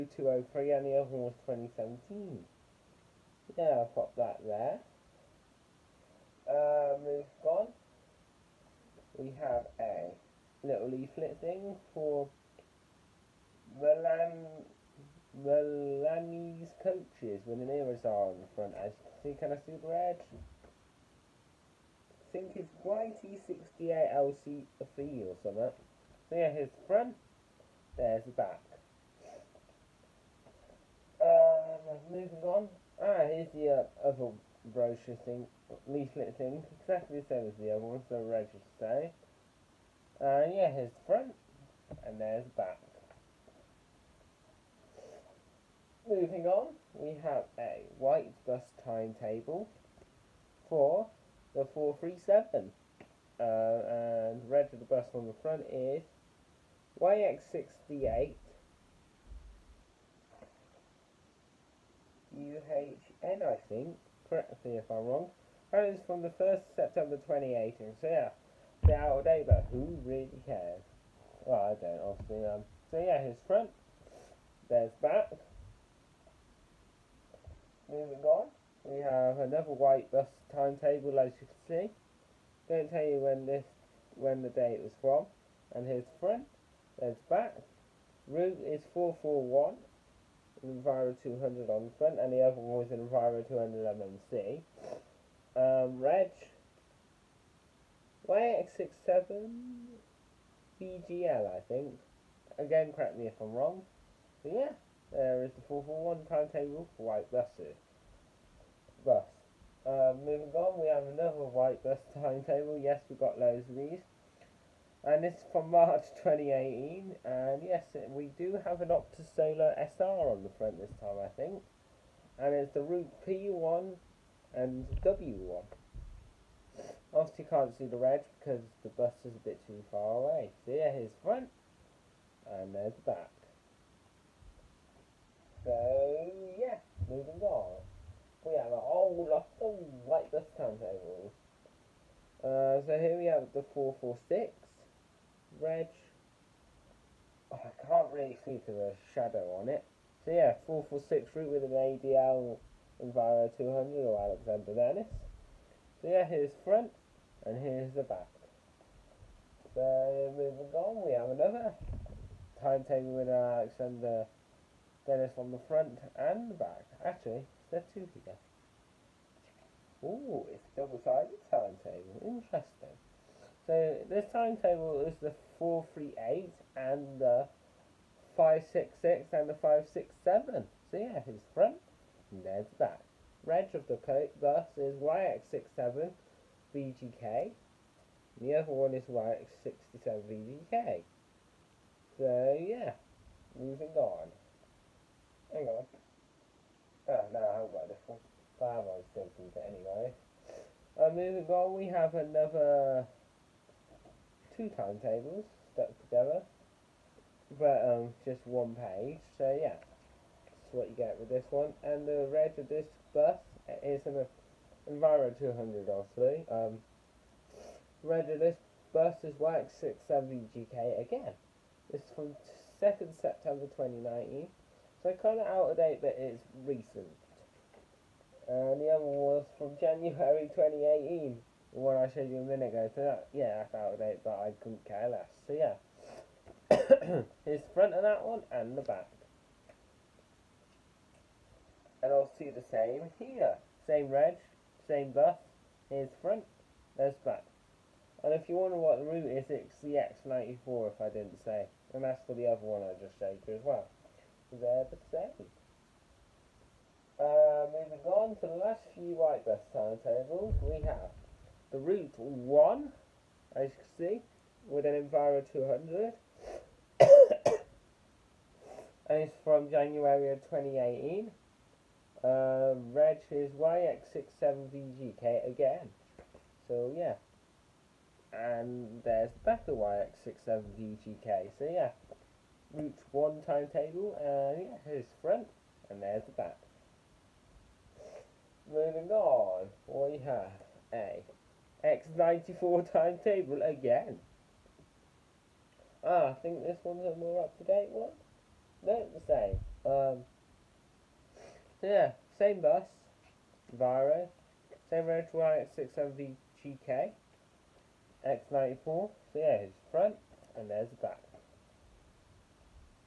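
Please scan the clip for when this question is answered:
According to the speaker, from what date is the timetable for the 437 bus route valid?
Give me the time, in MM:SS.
01:06.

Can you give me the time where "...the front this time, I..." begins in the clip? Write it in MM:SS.
02:00.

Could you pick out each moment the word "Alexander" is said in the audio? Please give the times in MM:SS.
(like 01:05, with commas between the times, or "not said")
02:34, 02:43.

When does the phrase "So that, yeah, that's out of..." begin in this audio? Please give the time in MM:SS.
03:52.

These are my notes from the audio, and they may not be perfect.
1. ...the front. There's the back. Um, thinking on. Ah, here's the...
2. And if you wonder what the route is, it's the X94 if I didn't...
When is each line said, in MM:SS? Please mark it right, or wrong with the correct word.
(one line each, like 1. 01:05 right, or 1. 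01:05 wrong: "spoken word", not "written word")
1. 00:26 wrong: "moving", not "thinking"
2. 04:08 right.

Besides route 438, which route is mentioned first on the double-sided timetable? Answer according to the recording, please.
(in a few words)
566.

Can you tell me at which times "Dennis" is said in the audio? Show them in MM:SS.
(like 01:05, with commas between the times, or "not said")
02:34, 02:45.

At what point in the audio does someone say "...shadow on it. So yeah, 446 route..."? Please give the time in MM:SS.
02:29.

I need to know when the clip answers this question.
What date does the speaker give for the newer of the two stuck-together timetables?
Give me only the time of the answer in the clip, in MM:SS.
03:42.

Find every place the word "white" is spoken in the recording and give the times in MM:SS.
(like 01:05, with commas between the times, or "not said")
00:47, 01:19, 01:47, 01:51, 04:19.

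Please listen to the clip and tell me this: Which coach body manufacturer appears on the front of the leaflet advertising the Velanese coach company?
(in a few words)
Irizar.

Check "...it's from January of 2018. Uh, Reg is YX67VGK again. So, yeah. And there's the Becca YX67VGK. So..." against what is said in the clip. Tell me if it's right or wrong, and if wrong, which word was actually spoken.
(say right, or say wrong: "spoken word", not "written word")
right.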